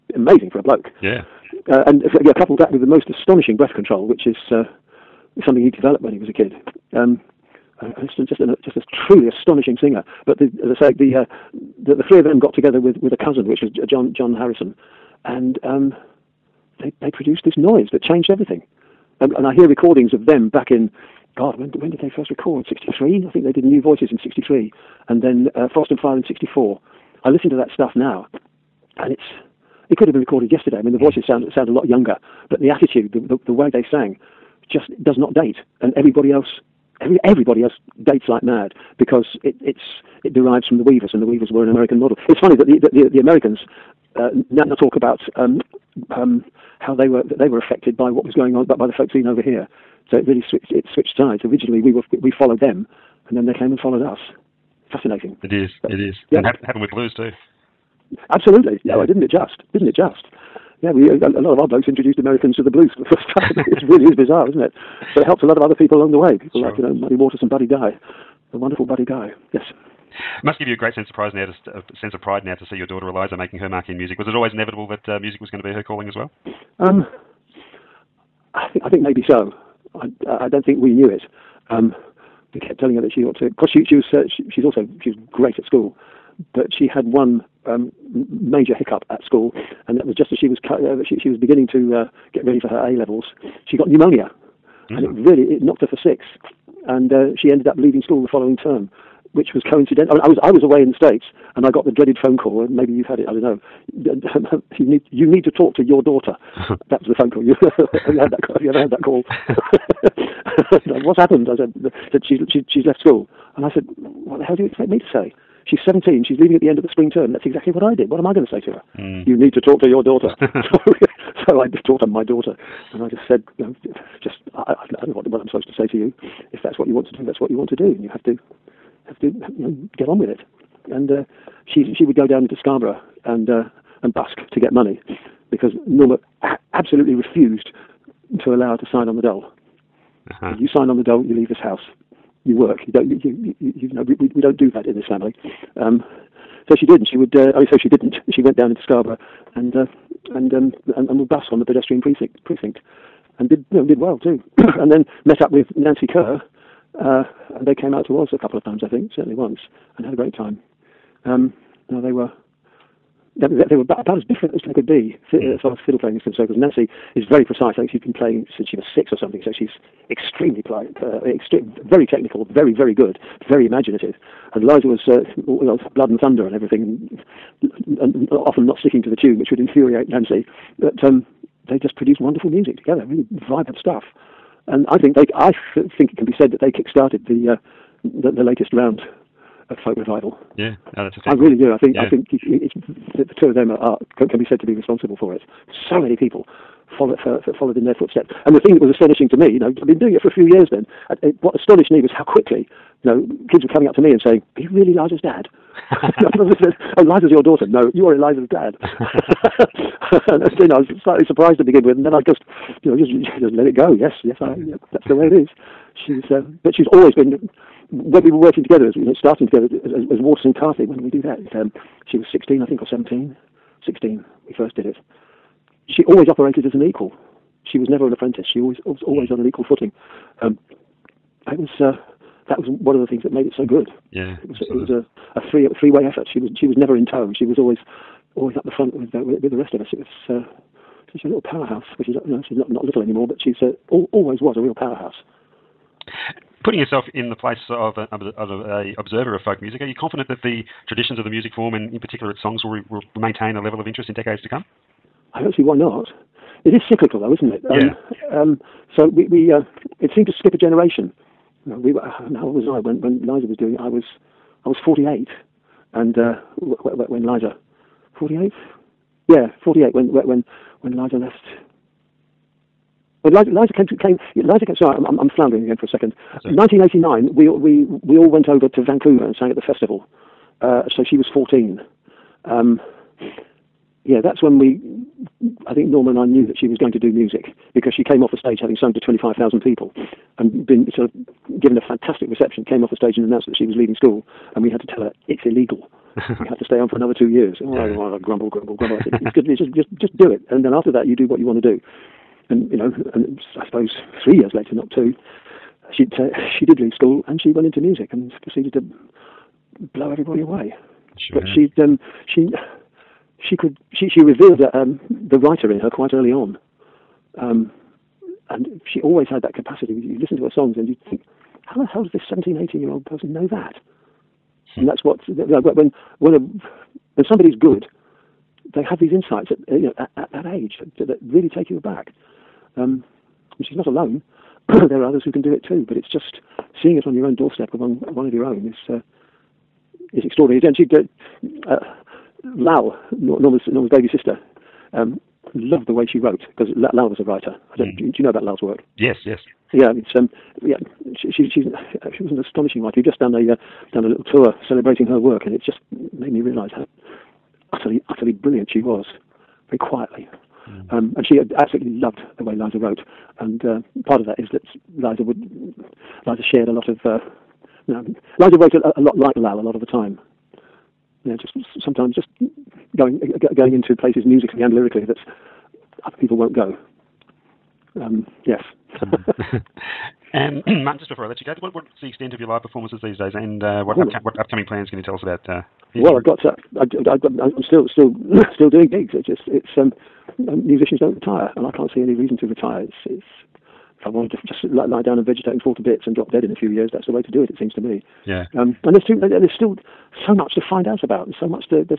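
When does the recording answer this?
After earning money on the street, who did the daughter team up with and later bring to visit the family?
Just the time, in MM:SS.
02:35.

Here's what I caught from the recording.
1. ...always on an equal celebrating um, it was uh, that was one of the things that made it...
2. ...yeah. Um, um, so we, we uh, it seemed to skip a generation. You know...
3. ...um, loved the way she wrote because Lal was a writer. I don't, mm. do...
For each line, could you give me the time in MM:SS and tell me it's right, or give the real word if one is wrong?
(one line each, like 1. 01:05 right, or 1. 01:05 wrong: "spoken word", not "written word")
1. 03:49 wrong: "footing", not "celebrating"
2. 04:17 right
3. 05:44 right.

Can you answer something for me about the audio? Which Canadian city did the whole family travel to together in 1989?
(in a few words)
Vancouver.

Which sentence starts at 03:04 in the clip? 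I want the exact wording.
And I think they, I think it can be said that they kick-started the, uh, the, the latest round of folk revival.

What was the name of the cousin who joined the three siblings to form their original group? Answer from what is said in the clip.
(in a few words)
John Harrison.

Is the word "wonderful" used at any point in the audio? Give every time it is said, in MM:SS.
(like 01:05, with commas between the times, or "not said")
01:08, 03:02.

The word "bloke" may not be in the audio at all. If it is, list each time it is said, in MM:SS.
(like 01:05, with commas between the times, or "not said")
00:00, 01:01.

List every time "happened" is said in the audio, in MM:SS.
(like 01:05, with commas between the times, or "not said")
00:56, 01:51.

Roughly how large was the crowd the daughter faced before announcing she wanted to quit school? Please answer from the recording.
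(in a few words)
25,000.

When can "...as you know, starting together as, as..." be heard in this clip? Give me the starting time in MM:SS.
03:38.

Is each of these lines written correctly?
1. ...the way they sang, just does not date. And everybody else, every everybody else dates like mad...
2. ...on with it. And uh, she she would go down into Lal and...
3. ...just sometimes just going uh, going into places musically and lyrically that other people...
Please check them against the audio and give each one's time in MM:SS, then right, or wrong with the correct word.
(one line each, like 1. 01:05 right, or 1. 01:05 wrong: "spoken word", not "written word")
1. 00:33 right
2. 02:10 wrong: "Scarborough", not "Lal"
3. 06:11 right.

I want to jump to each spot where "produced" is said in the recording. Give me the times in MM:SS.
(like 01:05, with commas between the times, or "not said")
00:17, 03:01.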